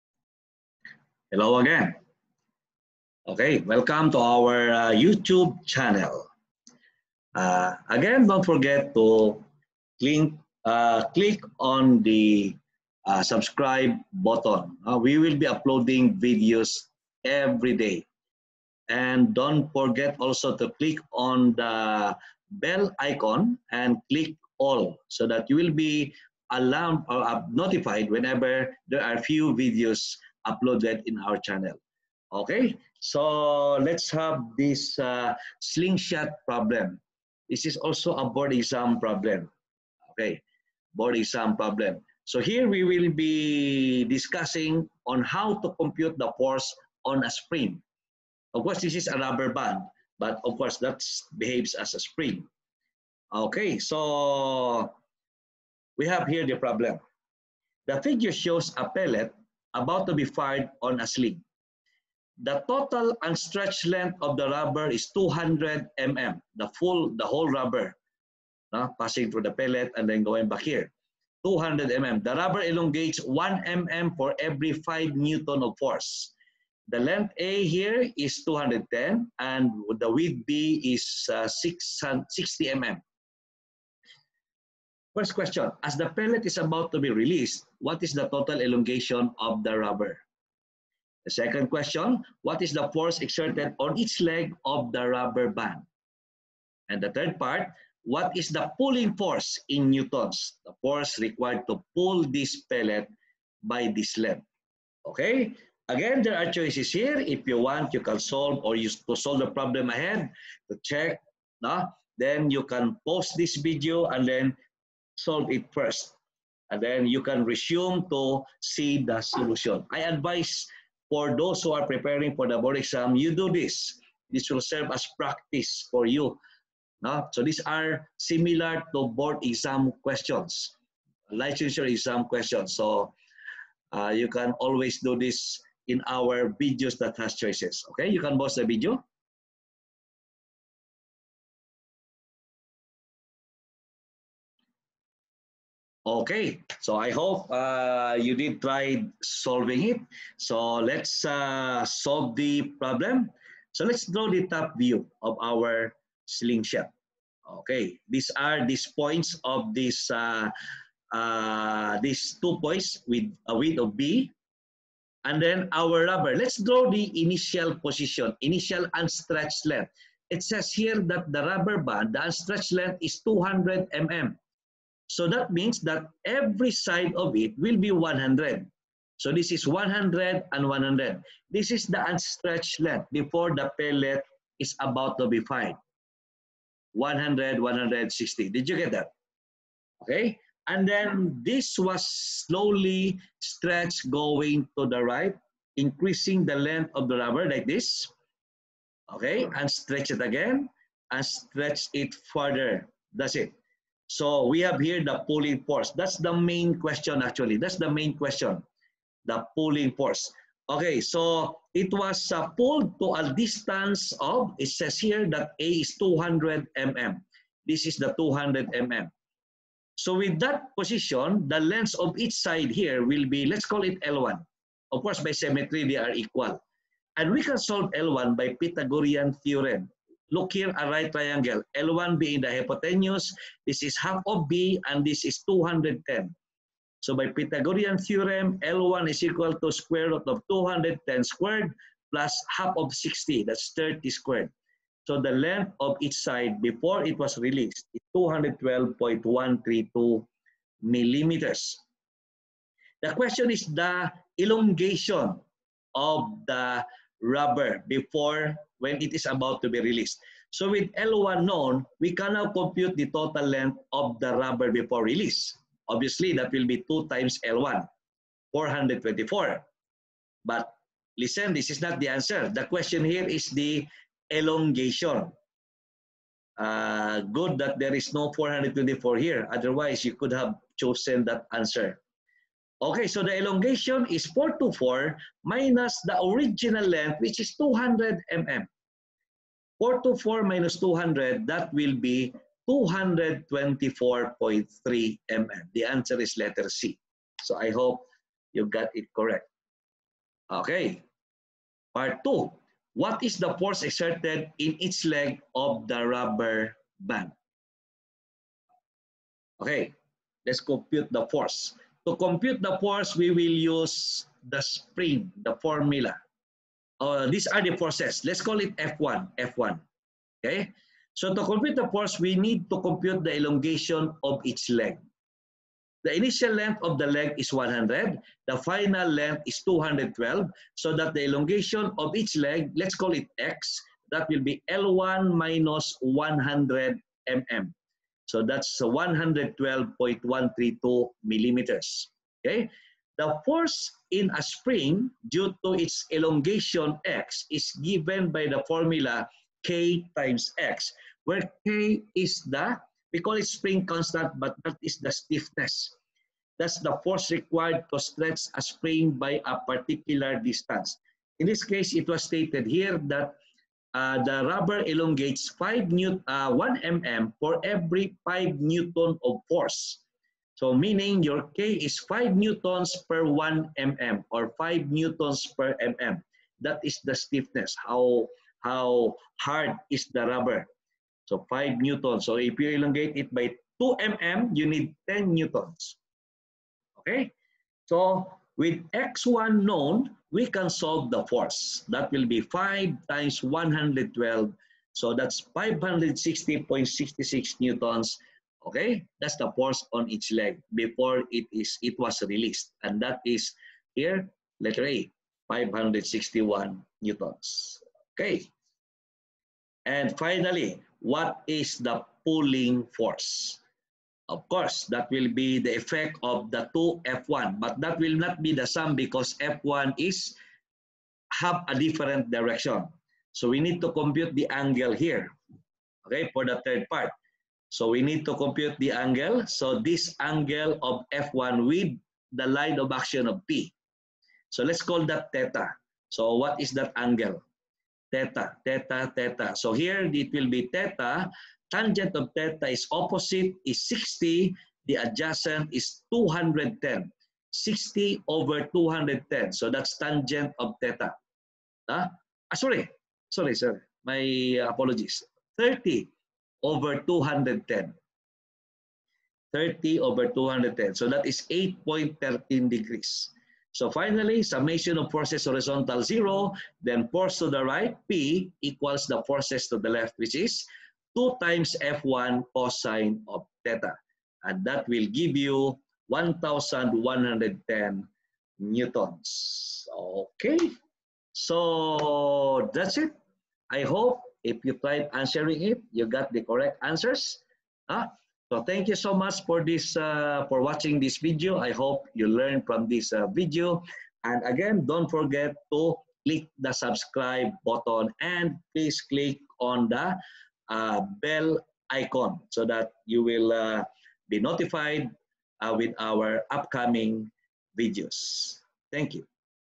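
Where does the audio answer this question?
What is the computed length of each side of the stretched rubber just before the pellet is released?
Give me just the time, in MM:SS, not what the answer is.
04:08.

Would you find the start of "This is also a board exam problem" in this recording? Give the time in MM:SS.
00:37.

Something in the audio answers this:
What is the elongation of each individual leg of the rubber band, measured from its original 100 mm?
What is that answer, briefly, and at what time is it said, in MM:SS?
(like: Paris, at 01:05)
112.132 millimeters, at 05:38.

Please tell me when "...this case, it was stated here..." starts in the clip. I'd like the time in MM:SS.
06:01.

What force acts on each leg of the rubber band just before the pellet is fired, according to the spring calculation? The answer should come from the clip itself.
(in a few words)
560.66 newtons.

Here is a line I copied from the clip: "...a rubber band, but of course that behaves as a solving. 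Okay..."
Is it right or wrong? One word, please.
wrong.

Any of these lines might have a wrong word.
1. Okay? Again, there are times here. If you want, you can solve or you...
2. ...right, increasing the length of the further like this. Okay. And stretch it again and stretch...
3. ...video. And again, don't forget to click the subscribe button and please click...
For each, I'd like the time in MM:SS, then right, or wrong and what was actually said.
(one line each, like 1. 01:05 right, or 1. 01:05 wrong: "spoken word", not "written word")
1. 01:45 wrong: "choices", not "times"
2. 03:15 wrong: "rubber", not "further"
3. 08:13 right.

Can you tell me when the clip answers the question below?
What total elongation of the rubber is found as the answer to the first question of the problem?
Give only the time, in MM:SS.
04:52.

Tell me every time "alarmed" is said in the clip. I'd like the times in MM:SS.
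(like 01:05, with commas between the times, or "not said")
00:26.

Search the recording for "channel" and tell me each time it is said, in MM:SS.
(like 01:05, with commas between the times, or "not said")
00:05, 00:31.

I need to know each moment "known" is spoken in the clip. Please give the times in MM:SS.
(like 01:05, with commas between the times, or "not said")
04:21, 06:29.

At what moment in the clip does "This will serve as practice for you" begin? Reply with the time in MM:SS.
02:04.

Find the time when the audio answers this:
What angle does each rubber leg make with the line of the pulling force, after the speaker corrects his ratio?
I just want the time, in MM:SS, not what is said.
07:41.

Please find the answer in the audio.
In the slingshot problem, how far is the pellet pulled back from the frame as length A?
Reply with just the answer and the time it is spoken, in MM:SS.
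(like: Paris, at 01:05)
210, at 01:16.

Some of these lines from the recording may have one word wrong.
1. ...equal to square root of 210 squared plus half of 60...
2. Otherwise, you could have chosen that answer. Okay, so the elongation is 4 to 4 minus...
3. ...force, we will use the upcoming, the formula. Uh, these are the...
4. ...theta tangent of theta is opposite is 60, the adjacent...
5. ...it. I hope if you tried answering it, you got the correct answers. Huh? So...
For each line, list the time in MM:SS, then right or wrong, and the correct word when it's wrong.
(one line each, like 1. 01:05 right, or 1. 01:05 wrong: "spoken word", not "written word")
1. 03:59 right
2. 04:39 right
3. 05:12 wrong: "spring", not "upcoming"
4. 07:20 right
5. 08:02 right.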